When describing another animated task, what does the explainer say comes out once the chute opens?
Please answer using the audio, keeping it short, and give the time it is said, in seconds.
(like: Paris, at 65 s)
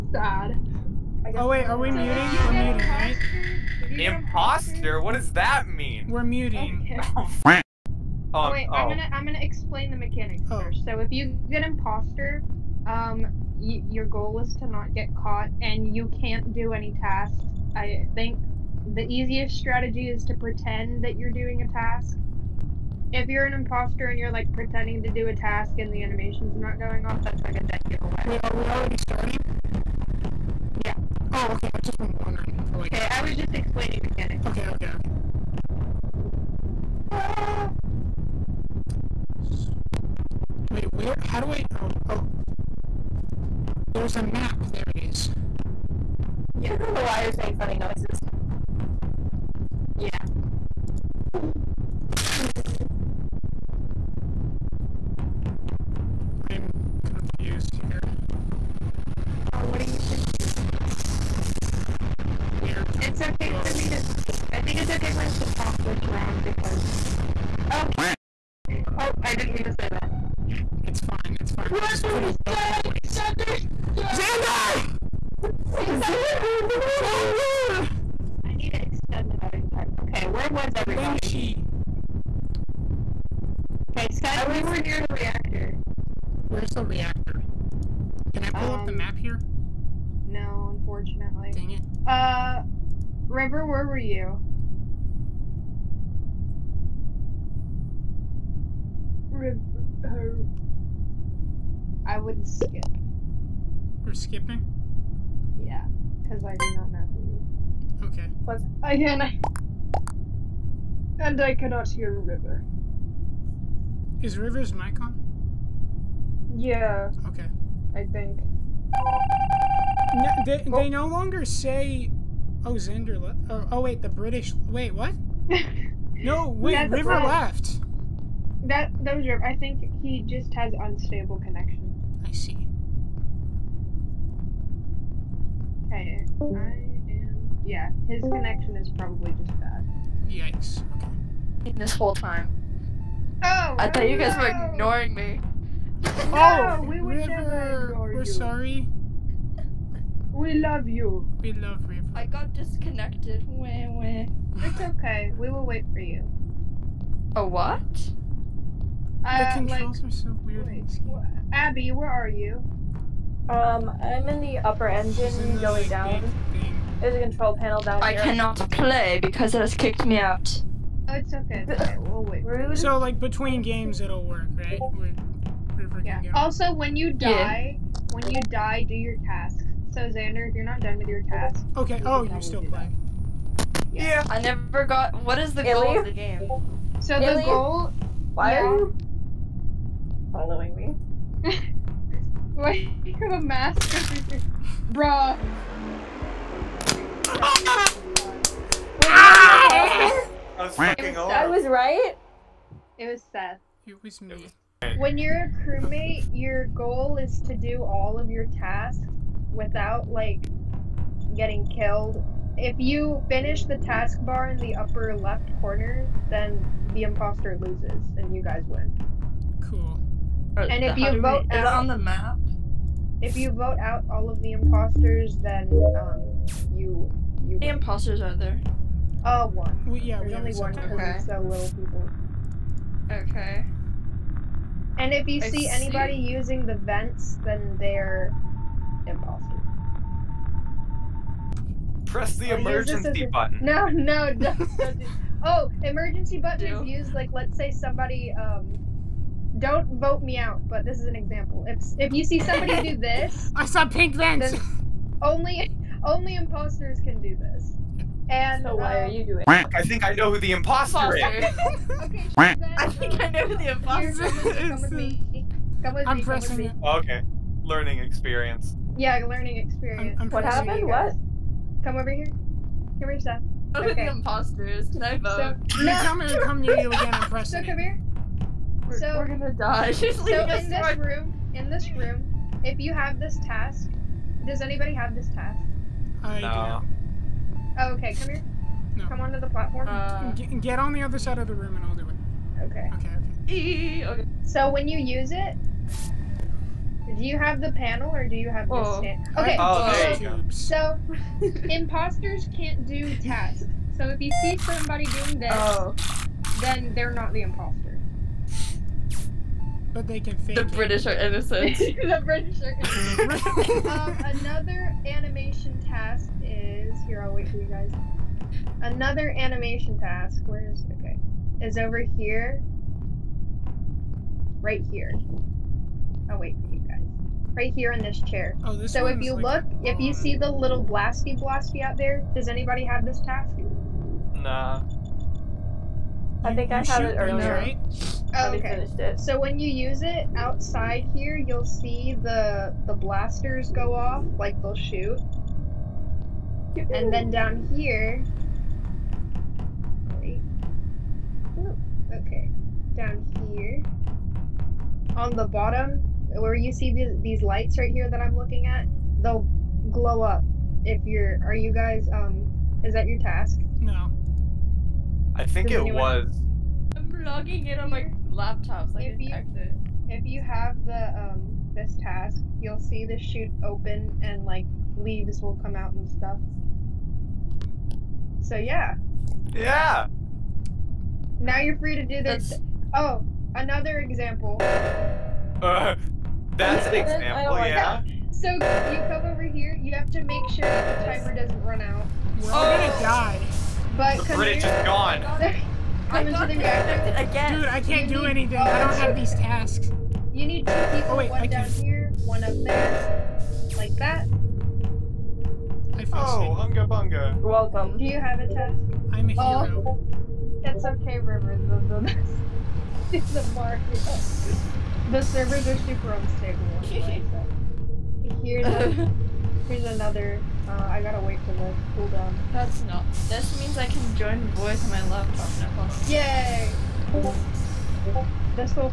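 Leaves, at 374 s.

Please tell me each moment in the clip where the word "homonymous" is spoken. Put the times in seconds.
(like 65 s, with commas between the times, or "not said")
not said.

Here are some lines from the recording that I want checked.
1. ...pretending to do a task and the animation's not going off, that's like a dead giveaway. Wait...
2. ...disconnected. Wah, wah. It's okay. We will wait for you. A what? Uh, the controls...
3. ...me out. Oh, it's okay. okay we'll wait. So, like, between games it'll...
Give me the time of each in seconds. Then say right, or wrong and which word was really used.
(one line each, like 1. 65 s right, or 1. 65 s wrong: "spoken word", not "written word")
1. 24 s right
2. 152 s right
3. 170 s right.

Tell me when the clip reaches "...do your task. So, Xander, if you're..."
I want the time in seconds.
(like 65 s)
178 s.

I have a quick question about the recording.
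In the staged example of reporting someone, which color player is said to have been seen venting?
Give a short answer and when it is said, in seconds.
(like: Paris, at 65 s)
Pink, at 253 s.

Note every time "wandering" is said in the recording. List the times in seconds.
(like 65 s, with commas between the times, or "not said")
32 s.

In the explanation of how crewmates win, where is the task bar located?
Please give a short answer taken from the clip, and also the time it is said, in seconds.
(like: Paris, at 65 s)
Upper left corner, at 214 s.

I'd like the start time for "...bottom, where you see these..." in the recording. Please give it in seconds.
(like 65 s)
355 s.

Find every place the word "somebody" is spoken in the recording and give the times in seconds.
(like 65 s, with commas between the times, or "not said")
247 s, 252 s, 304 s.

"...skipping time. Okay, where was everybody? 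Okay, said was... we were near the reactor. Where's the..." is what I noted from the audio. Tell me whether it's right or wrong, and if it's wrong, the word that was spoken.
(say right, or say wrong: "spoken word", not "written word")
wrong: "voting", not "skipping".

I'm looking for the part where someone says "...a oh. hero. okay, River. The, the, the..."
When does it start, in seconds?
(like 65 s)
409 s.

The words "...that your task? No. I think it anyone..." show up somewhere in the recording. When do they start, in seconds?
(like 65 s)
362 s.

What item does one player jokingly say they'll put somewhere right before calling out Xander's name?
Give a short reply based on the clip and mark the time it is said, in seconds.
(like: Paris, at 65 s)
A duck, at 71 s.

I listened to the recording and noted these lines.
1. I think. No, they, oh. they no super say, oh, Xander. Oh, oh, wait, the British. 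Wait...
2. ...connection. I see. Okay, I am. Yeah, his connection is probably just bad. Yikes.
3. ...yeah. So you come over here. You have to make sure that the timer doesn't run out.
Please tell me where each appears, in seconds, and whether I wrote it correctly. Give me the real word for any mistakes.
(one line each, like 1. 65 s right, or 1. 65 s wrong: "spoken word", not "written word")
1. 117 s wrong: "longer", not "super"
2. 131 s right
3. 387 s right.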